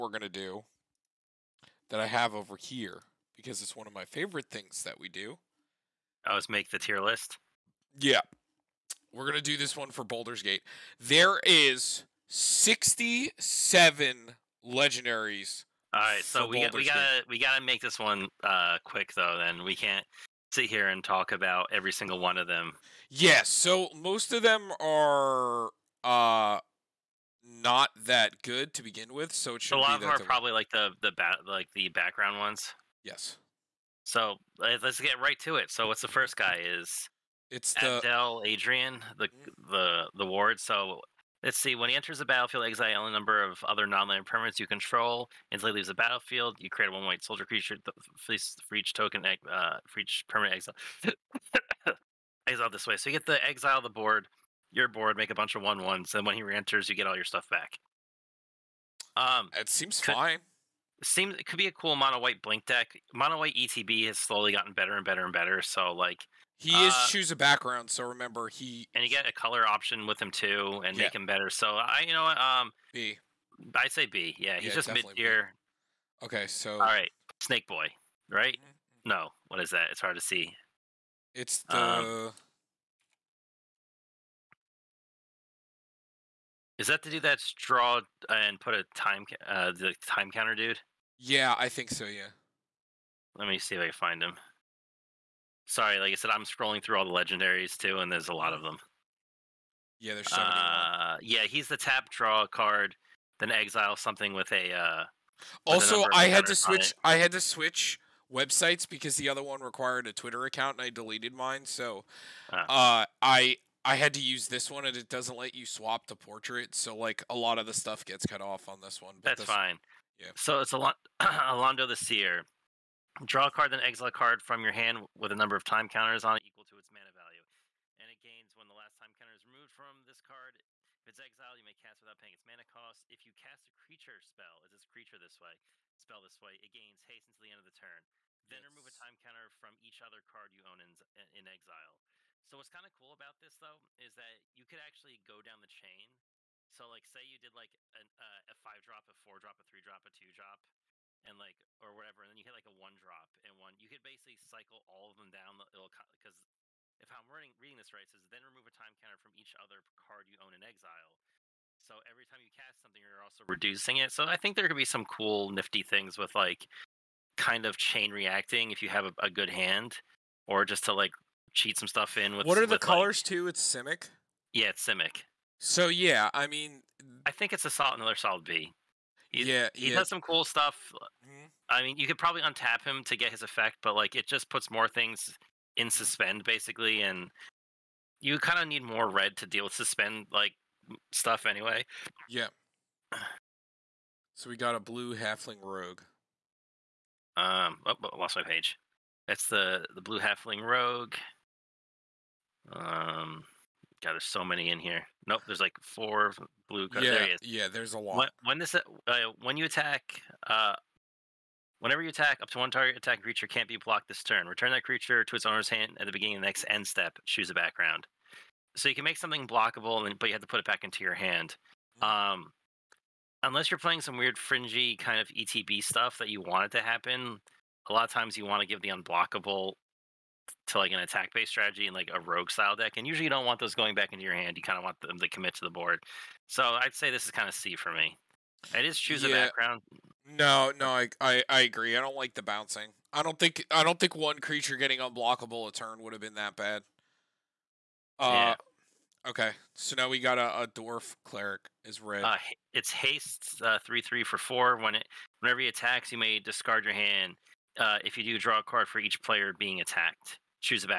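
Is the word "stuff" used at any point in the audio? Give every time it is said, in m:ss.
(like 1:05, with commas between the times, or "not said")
0:57, 1:57, 2:51, 3:00, 3:11, 3:45.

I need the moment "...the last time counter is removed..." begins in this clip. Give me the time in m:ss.
2:08.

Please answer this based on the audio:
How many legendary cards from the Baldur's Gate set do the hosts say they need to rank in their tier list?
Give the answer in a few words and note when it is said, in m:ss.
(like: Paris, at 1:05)
67, at 0:12.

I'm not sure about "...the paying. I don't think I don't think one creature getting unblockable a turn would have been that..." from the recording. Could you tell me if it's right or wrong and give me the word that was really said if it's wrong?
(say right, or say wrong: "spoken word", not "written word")
wrong: "bouncing", not "paying".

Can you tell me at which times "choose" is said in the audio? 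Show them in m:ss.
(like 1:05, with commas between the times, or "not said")
1:07, 3:37, 3:58.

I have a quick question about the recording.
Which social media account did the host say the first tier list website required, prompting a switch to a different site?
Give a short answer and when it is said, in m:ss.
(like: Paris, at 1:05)
Twitter, at 1:50.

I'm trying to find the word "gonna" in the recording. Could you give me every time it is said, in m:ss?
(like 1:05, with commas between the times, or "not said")
0:00, 0:09.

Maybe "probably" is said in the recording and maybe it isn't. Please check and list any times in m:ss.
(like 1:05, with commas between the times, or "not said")
0:30, 3:02.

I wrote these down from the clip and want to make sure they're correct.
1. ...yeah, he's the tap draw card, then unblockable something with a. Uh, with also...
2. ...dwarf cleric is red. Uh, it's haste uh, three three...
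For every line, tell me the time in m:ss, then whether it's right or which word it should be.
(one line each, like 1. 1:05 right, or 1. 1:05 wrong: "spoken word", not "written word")
1. 1:41 wrong: "exile", not "unblockable"
2. 4:10 right.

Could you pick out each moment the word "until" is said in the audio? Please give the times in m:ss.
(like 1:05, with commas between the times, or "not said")
0:45, 2:17.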